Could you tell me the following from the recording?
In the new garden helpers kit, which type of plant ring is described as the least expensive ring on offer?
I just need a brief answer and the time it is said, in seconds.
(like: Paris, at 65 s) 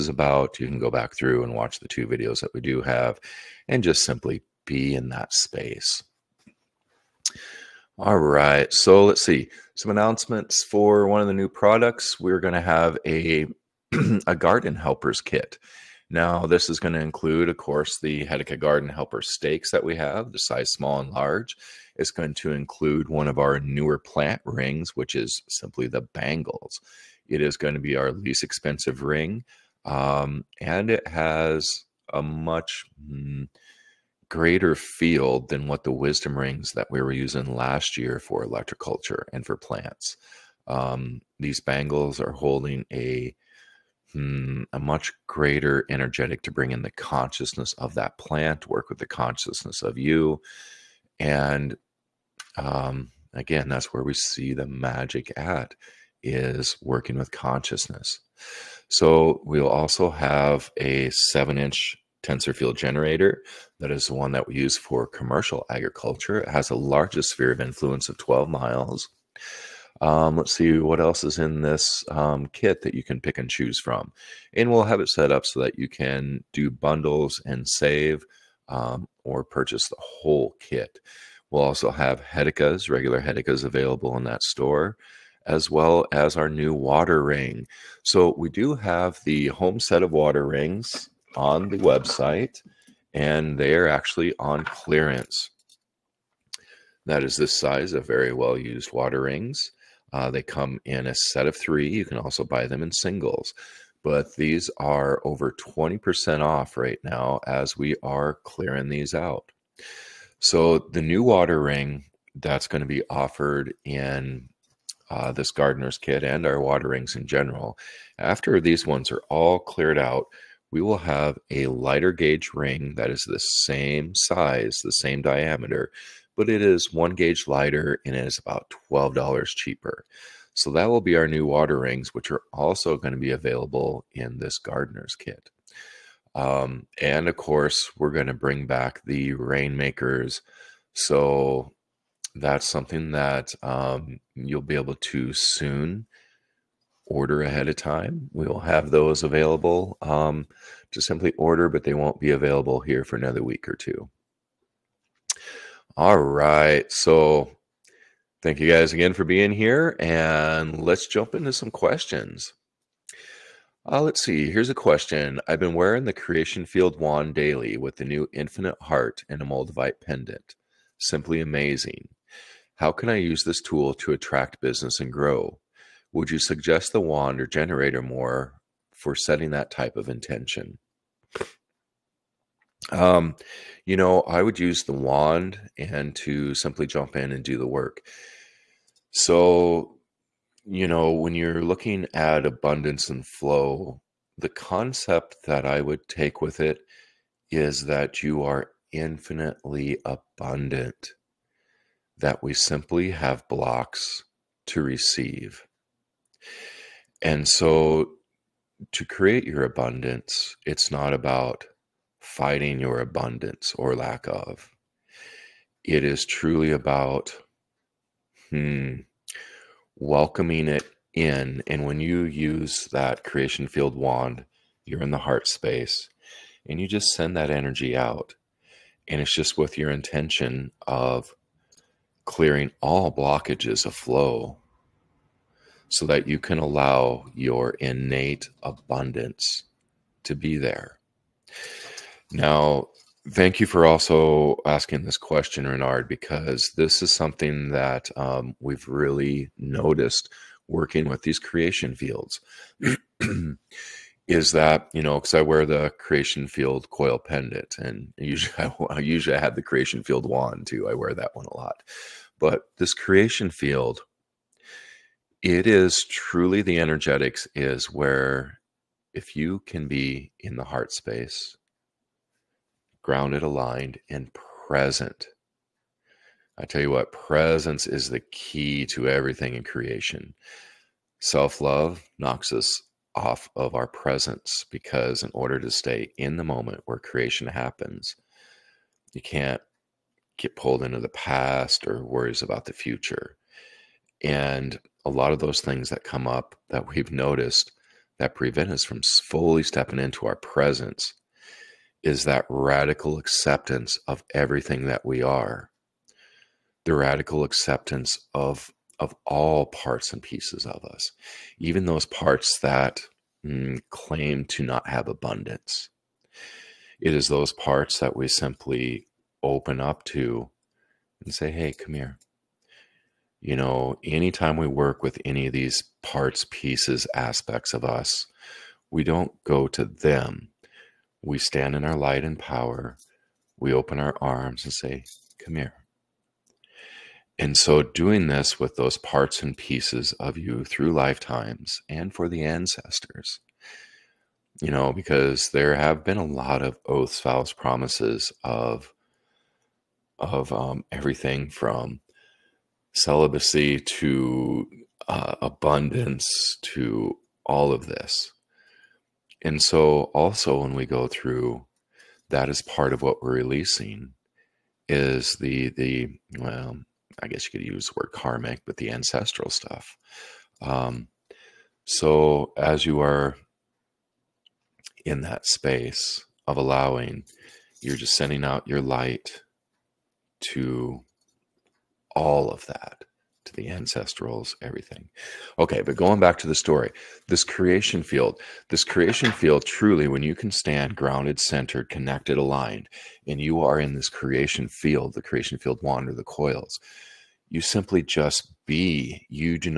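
the bangles, at 25 s.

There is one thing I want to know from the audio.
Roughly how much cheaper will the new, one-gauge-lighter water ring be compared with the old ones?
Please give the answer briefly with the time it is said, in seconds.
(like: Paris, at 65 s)
about $12, at 128 s.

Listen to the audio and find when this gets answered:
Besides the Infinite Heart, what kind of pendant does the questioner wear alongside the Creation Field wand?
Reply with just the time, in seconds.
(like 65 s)
169 s.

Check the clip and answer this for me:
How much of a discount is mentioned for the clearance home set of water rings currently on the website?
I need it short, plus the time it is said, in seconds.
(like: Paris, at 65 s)
over 20% off, at 105 s.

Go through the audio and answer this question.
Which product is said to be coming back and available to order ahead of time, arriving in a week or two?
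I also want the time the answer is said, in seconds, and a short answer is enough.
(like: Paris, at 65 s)
the Rainmakers, at 139 s.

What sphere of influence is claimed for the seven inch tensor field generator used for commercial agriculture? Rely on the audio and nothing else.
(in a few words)
12 miles.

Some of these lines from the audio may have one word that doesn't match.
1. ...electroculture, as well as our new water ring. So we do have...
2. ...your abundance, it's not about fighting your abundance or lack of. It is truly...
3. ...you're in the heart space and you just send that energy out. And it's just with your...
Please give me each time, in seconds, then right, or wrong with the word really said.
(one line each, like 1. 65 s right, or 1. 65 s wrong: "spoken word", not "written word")
1. 84 s wrong: "store", not "electroculture"
2. 209 s right
3. 224 s right.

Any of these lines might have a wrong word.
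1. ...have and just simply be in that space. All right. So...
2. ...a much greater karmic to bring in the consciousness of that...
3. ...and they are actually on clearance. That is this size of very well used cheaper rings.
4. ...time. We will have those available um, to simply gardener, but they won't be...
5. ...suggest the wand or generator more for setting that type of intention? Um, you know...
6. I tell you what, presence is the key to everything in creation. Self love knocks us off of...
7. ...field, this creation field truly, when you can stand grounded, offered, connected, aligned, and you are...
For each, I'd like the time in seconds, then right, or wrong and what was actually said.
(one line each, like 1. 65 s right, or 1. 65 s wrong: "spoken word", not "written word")
1. 2 s right
2. 44 s wrong: "energetic", not "karmic"
3. 93 s wrong: "water", not "cheaper"
4. 147 s wrong: "order", not "gardener"
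5. 176 s right
6. 276 s right
7. 388 s wrong: "centered", not "offered".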